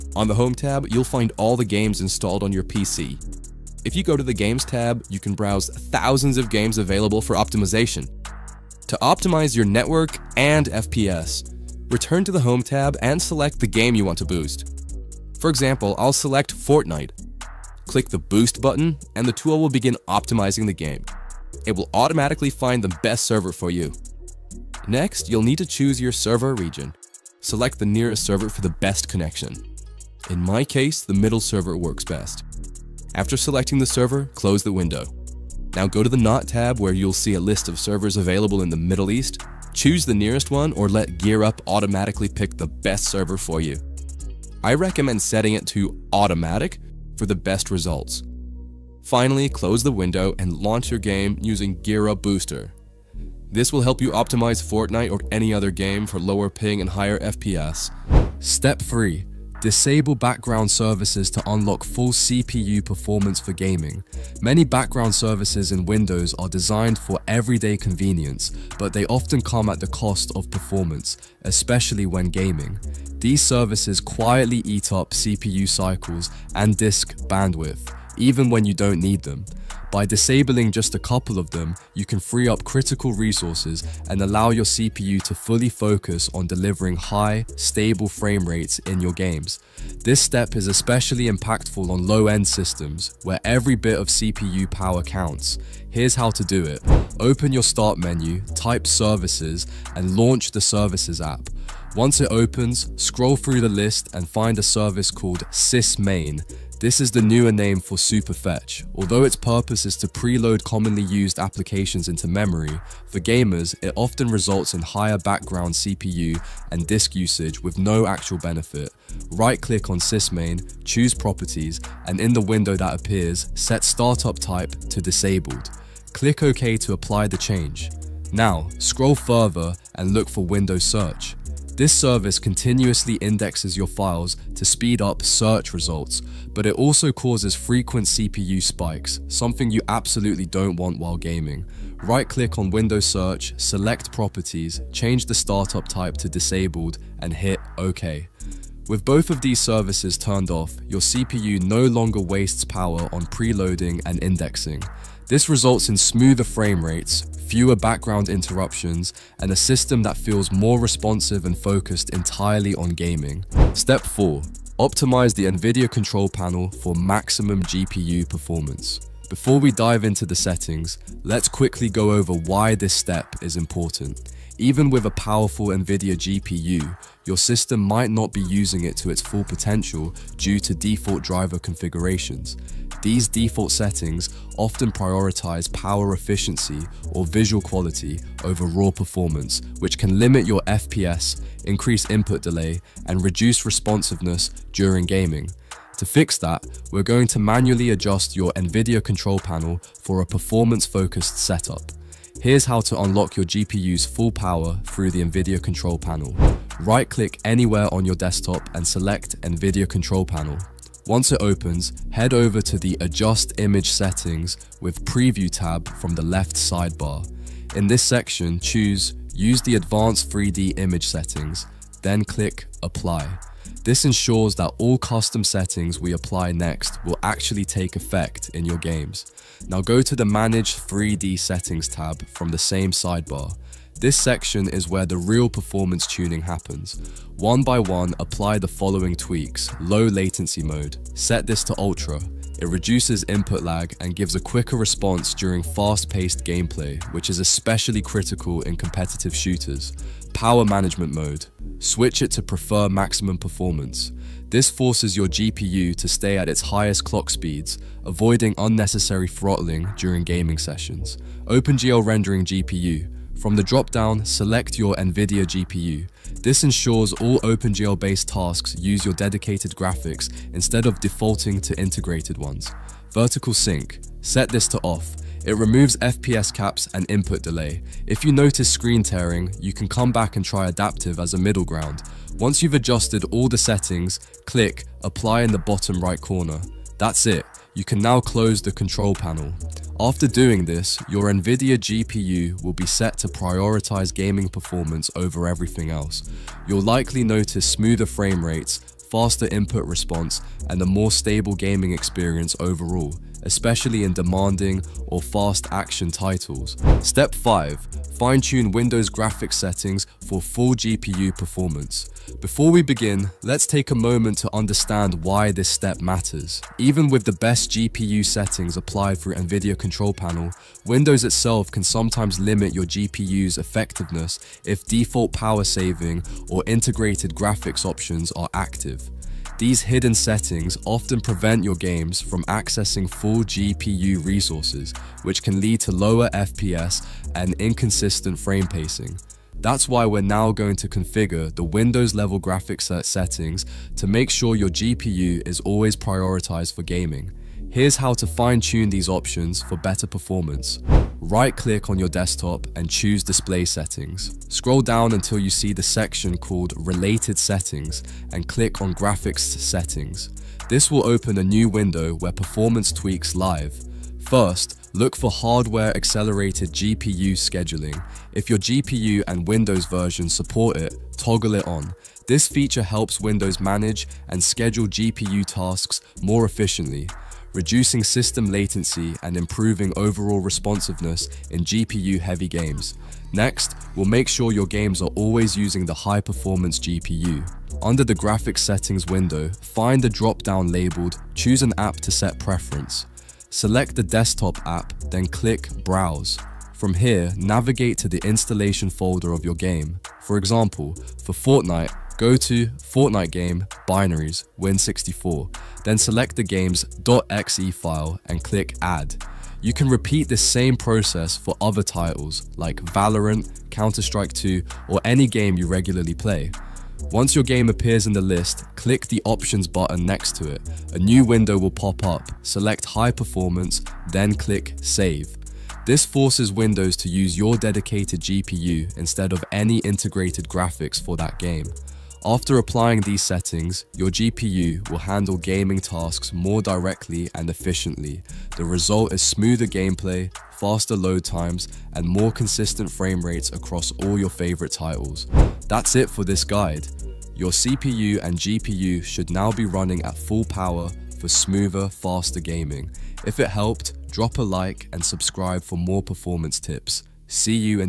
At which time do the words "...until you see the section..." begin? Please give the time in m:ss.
5:55.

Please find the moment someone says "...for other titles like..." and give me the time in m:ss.
6:51.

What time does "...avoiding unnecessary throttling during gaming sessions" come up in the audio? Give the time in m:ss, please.
4:18.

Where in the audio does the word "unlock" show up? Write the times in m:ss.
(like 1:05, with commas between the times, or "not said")
1:01, 3:22.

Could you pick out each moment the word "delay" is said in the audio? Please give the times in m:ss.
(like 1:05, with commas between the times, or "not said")
3:12, 4:37.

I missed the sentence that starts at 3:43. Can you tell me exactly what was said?
This ensures that all custom settings we apply next will actually take effect in your games.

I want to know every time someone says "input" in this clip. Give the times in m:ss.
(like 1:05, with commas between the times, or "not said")
3:12, 4:03, 4:37, 4:59.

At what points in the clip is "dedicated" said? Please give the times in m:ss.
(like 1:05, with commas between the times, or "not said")
4:29, 7:07.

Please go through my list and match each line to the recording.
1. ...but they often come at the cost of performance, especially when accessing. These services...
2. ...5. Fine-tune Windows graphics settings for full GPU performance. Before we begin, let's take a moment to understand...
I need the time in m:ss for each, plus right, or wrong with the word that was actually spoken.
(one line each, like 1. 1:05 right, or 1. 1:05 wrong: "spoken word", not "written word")
1. 1:08 wrong: "gaming", not "accessing"
2. 5:07 right.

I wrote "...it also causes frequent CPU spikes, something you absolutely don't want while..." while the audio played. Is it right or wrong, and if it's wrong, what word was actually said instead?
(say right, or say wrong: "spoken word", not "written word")
right.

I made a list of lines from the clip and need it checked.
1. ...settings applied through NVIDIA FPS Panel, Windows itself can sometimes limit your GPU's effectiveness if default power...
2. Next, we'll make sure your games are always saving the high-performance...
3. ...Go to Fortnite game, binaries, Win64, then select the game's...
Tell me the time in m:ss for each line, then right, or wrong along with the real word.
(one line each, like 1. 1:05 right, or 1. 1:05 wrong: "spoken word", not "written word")
1. 5:18 wrong: "Control", not "FPS"
2. 6:23 wrong: "using", not "saving"
3. 6:42 right.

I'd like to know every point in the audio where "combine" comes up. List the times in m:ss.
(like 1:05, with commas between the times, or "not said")
not said.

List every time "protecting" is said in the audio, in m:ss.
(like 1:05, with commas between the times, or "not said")
not said.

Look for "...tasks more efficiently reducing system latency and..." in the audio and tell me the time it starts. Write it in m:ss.
6:15.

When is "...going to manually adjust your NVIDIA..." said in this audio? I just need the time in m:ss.
3:17.